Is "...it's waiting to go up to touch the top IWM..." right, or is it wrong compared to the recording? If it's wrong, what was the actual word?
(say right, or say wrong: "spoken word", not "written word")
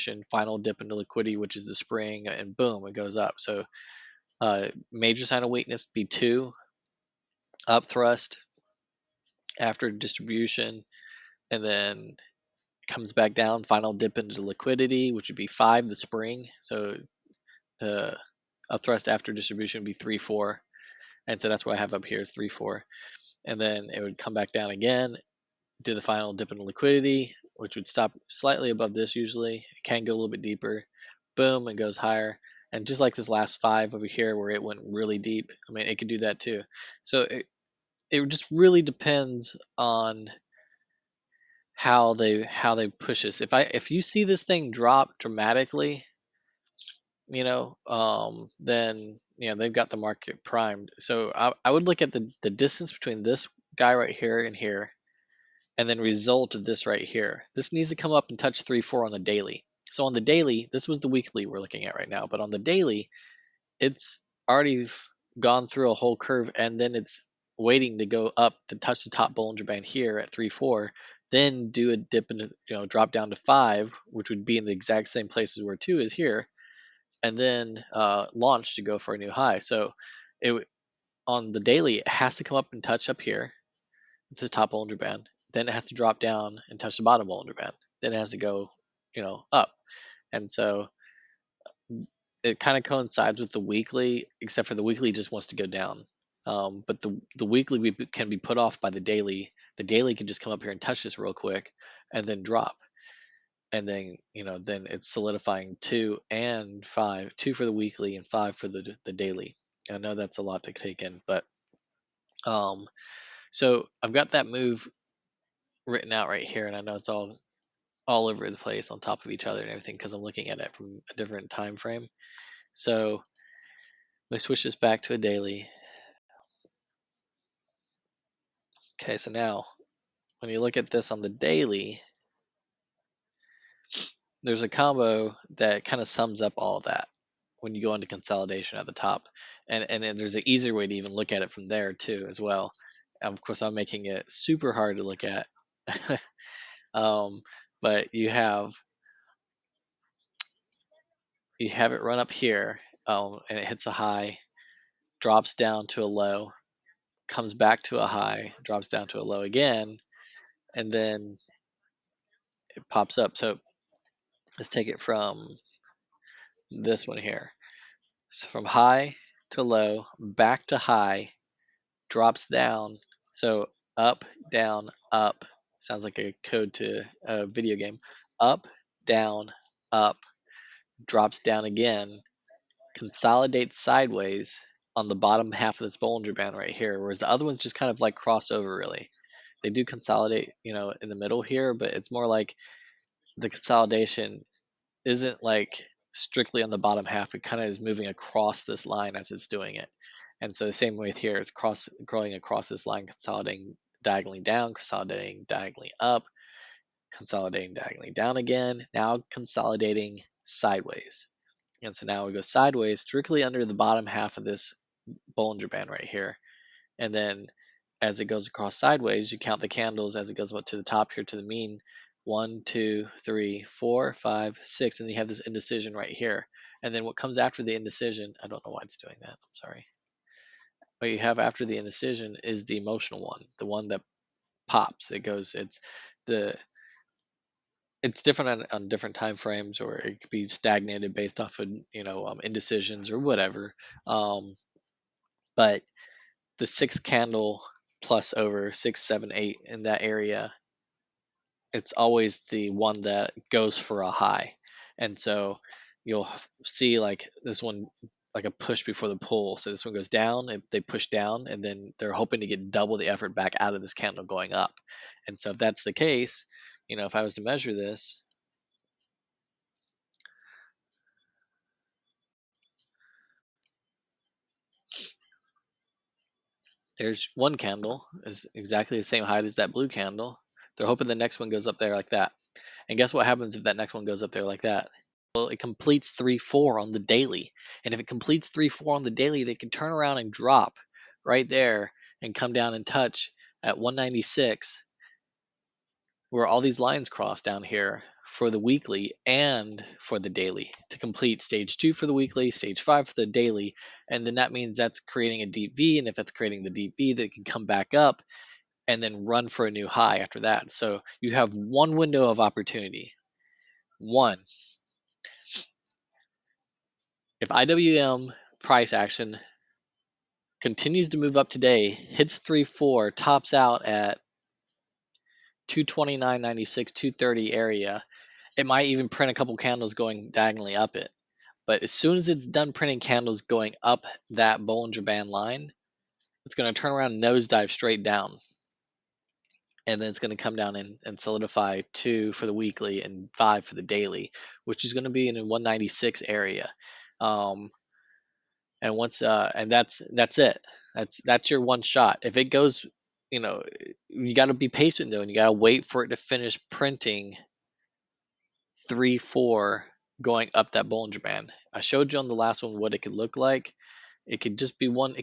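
wrong: "Bollinger", not "IWM".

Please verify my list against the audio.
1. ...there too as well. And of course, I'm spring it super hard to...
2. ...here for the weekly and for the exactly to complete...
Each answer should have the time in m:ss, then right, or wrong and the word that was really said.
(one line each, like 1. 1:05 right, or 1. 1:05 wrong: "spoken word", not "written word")
1. 2:21 wrong: "making", not "spring"
2. 4:57 wrong: "daily", not "exactly".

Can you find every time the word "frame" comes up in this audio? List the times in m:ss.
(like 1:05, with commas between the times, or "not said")
2:01, 3:59.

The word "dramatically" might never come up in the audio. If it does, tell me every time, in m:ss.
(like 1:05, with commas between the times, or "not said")
0:45.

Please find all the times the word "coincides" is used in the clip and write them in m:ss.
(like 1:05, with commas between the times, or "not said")
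1:32.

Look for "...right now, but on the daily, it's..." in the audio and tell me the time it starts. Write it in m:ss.
1:01.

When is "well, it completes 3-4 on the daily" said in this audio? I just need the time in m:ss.
4:45.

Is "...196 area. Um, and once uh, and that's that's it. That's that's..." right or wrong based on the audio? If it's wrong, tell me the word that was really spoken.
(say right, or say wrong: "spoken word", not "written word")
right.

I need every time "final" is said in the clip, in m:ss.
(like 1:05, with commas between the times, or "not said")
0:00, 0:13, 0:26.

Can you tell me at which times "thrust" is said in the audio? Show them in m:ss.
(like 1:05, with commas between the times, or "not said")
0:07, 0:18.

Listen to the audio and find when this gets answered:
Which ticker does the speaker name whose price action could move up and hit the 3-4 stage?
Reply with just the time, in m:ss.
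5:17.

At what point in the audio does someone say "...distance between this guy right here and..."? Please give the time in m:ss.
0:52.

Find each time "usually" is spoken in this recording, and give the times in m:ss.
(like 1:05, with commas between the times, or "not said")
0:29.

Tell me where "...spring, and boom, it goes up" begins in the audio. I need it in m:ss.
0:01.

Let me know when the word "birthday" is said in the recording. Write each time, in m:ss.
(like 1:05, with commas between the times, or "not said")
not said.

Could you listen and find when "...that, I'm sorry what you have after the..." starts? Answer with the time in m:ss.
3:49.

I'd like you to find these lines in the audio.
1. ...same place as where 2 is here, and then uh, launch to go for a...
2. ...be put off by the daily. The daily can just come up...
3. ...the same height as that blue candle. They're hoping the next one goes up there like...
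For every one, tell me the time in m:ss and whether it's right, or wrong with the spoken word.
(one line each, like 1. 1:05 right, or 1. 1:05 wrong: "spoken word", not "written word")
1. 1:15 right
2. 1:38 right
3. 4:38 right.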